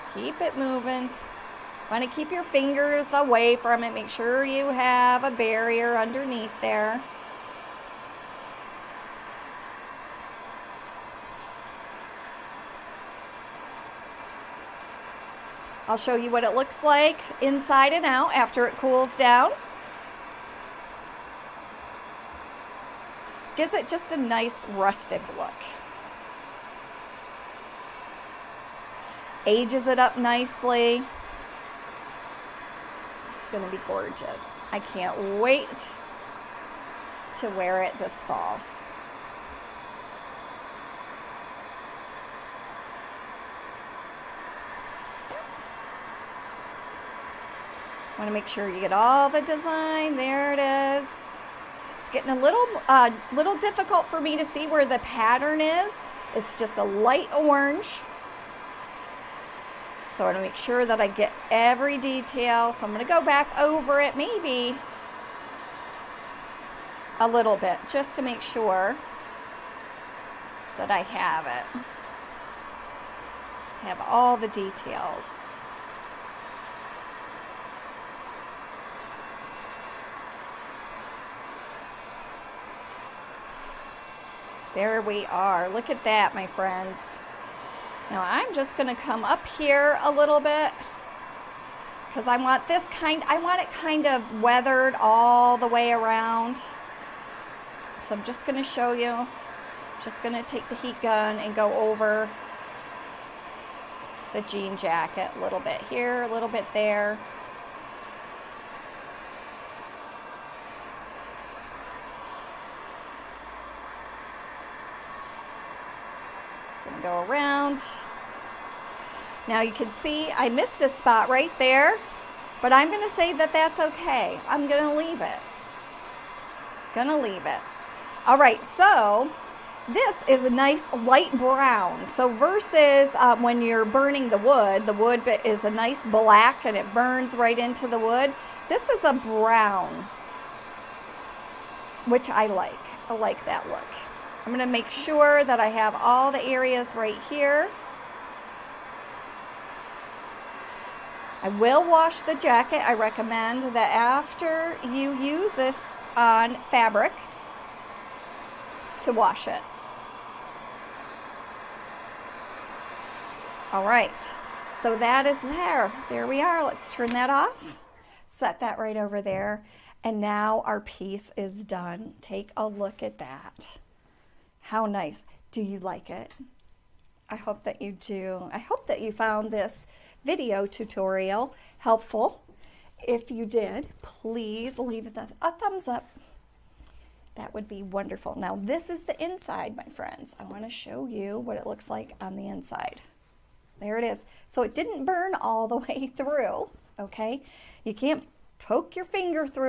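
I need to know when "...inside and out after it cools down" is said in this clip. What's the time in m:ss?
0:17.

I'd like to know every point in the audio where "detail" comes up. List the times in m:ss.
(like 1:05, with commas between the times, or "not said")
1:01, 1:14.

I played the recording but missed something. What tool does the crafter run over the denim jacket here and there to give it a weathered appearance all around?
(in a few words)
heat gun.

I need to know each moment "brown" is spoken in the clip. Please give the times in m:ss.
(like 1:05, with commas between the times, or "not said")
2:11, 2:19.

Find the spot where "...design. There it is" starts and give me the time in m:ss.
0:49.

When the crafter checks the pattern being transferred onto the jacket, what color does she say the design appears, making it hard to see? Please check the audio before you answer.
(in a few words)
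light orange.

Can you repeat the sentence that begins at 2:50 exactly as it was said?
And now our piece is done.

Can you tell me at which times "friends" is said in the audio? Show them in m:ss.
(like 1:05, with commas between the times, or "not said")
1:26, 3:09.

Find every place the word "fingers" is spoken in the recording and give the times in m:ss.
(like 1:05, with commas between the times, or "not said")
0:02, 3:19.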